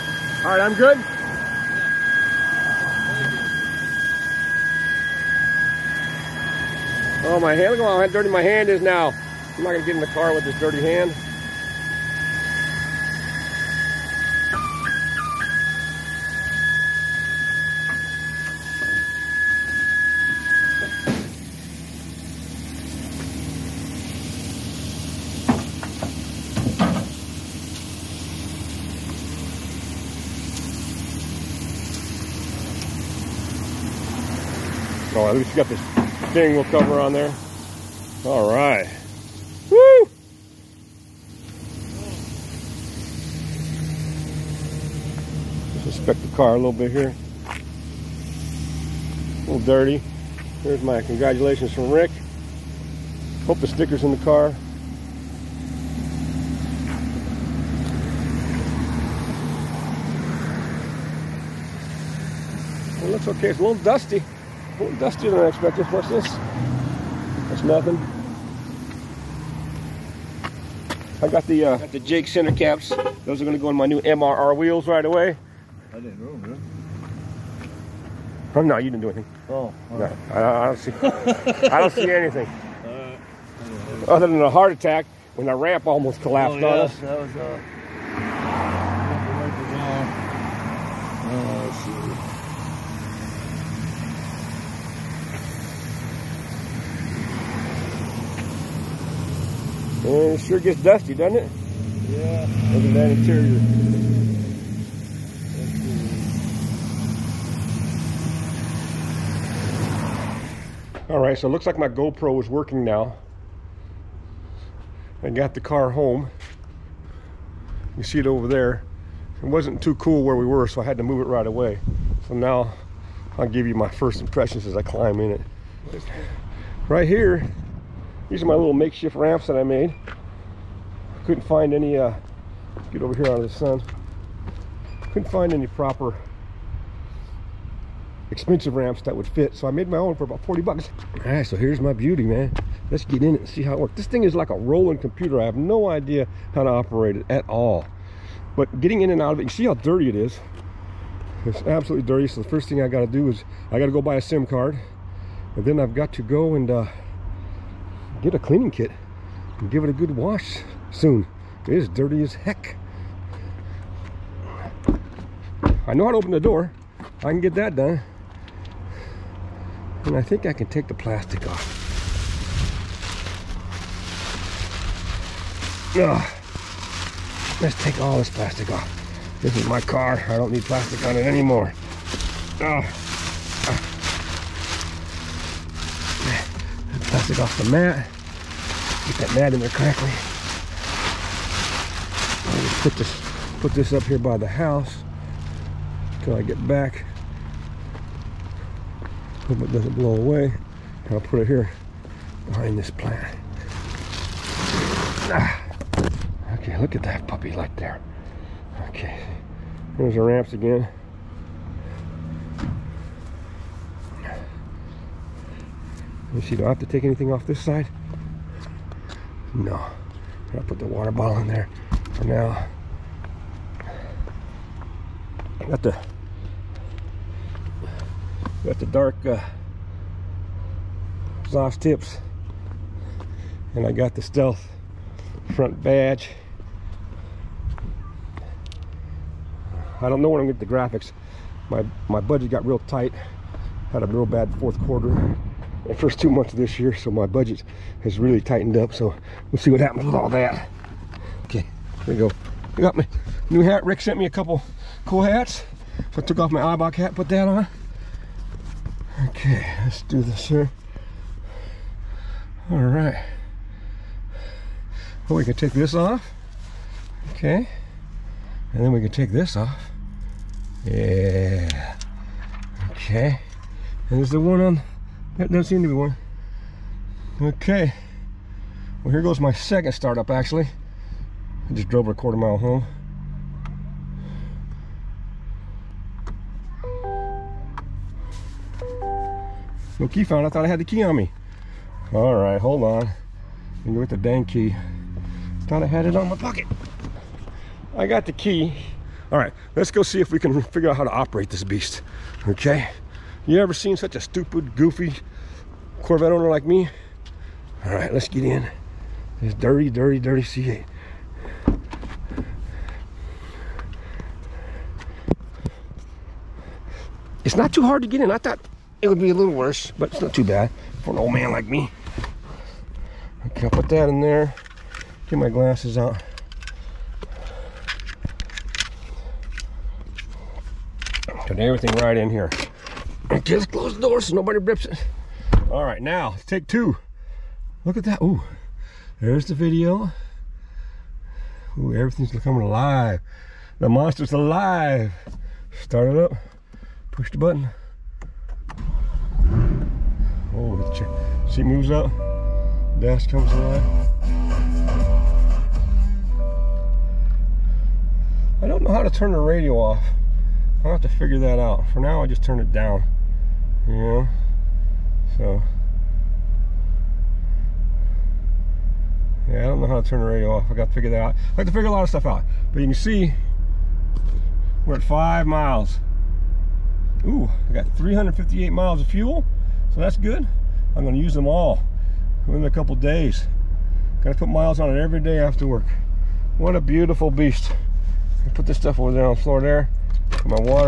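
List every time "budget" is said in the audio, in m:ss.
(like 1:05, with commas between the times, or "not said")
4:02, 4:07.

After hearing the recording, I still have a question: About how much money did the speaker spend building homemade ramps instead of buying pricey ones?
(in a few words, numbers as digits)
$40.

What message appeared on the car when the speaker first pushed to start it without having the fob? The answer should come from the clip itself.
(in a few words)
No key found.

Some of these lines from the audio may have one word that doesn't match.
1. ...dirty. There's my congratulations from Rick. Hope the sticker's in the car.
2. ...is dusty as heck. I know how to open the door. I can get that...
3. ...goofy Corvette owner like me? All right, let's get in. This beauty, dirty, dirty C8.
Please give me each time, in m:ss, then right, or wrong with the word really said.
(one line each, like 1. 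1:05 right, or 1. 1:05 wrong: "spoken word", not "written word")
1. 0:49 right
2. 2:41 wrong: "dirty", not "dusty"
3. 5:04 wrong: "dirty", not "beauty".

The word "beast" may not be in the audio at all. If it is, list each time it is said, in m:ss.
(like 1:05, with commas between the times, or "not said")
5:01, 6:27.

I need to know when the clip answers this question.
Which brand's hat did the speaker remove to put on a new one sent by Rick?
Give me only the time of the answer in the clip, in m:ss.
4:16.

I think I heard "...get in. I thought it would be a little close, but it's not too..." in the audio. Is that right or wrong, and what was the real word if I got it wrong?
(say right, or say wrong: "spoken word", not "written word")
wrong: "worse", not "close".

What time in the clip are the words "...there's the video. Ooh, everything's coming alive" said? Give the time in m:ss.
5:39.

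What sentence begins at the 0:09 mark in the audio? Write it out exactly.
I'm not gonna get in the car with this dirty hand.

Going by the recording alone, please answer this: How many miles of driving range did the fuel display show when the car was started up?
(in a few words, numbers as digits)
358.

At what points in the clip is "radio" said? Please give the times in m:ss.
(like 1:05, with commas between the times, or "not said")
5:59, 6:10.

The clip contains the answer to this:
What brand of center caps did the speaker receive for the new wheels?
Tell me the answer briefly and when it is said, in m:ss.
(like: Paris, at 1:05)
Jake center caps, at 1:11.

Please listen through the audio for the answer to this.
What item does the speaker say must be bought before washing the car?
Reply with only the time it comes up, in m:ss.
2:34.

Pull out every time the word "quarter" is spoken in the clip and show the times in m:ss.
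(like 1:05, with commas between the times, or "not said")
4:04, 4:42.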